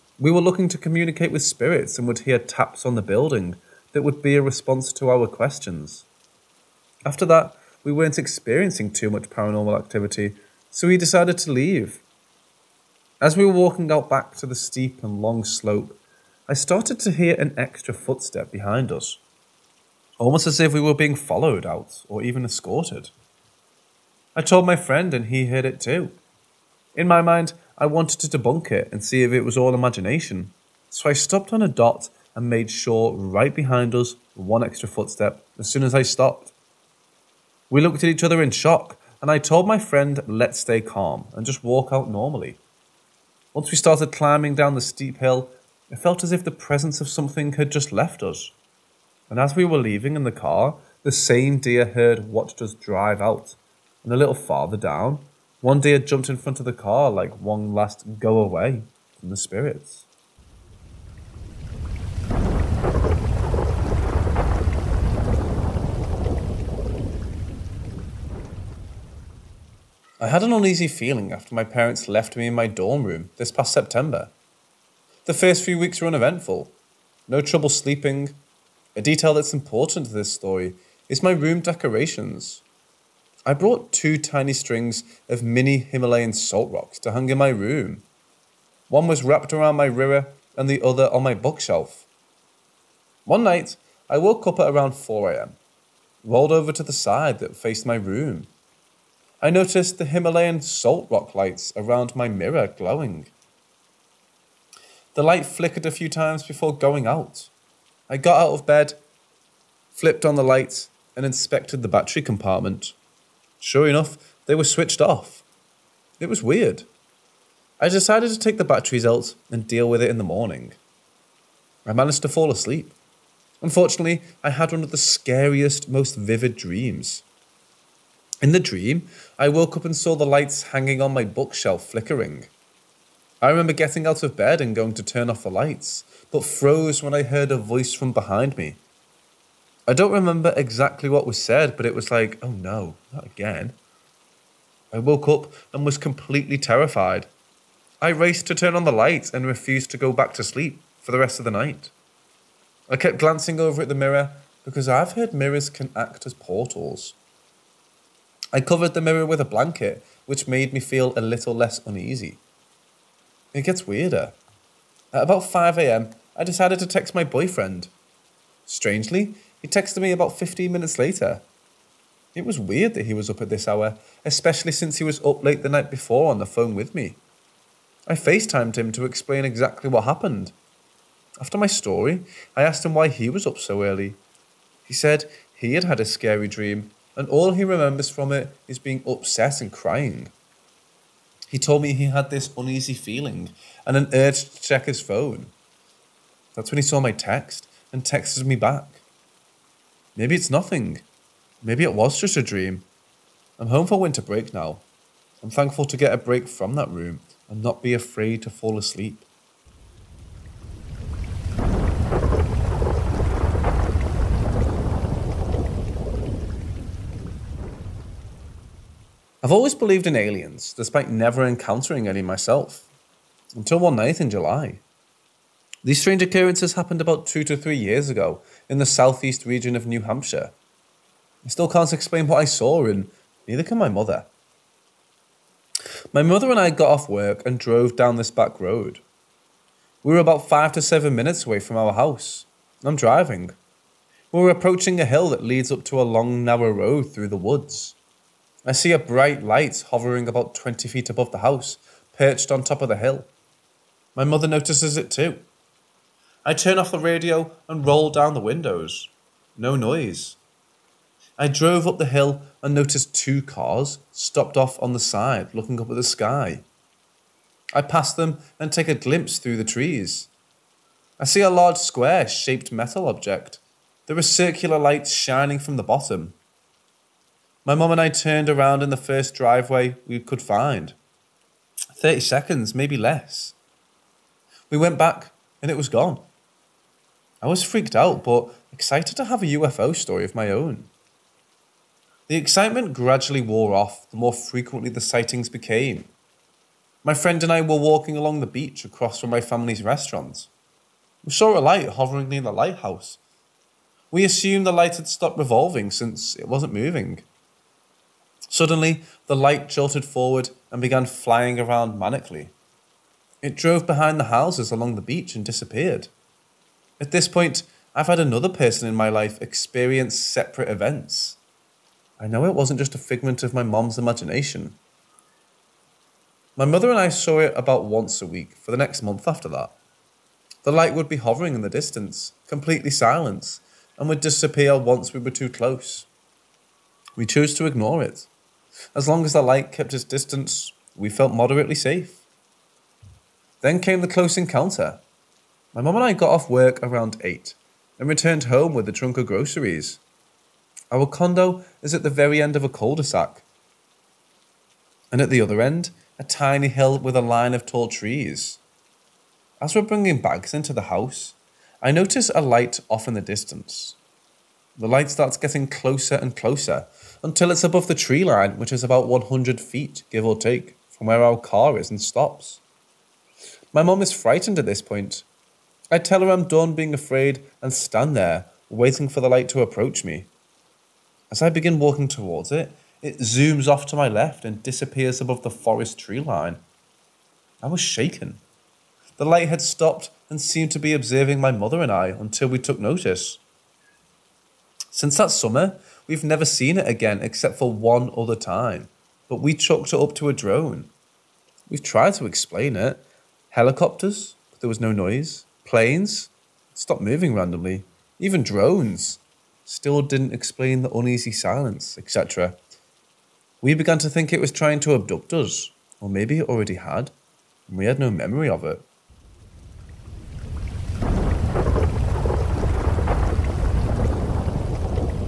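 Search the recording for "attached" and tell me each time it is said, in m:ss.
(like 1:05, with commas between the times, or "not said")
not said.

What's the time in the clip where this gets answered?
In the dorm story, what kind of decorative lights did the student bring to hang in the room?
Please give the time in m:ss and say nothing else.
1:25.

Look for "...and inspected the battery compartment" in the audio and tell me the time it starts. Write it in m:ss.
1:51.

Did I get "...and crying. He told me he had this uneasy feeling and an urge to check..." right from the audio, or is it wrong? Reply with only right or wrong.
right.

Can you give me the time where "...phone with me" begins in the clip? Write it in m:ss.
2:56.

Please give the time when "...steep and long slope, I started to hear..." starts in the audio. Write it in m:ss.
0:14.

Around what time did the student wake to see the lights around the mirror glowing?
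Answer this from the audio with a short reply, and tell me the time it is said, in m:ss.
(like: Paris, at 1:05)
4 am, at 1:34.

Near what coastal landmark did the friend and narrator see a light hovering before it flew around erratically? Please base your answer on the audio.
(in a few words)
The lighthouse.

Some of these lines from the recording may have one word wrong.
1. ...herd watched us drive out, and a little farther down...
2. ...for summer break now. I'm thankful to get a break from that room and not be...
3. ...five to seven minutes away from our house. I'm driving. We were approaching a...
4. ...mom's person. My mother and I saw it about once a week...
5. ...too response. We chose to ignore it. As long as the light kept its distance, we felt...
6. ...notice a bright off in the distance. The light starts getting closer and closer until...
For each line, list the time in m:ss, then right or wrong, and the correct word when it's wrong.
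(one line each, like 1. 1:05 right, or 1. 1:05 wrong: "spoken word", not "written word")
1. 0:51 right
2. 3:23 wrong: "winter", not "summer"
3. 4:00 right
4. 5:23 wrong: "imagination", not "person"
5. 5:35 wrong: "close", not "response"
6. 6:01 wrong: "light", not "bright".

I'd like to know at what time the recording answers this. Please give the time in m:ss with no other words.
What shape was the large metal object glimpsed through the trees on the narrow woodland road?
4:31.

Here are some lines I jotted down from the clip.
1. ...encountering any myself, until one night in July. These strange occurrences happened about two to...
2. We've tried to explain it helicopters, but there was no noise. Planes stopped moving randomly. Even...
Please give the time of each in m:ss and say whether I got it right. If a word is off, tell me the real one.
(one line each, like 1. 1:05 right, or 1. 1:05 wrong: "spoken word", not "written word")
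1. 3:41 right
2. 6:41 right.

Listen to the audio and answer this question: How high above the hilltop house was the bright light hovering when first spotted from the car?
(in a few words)
20 feet.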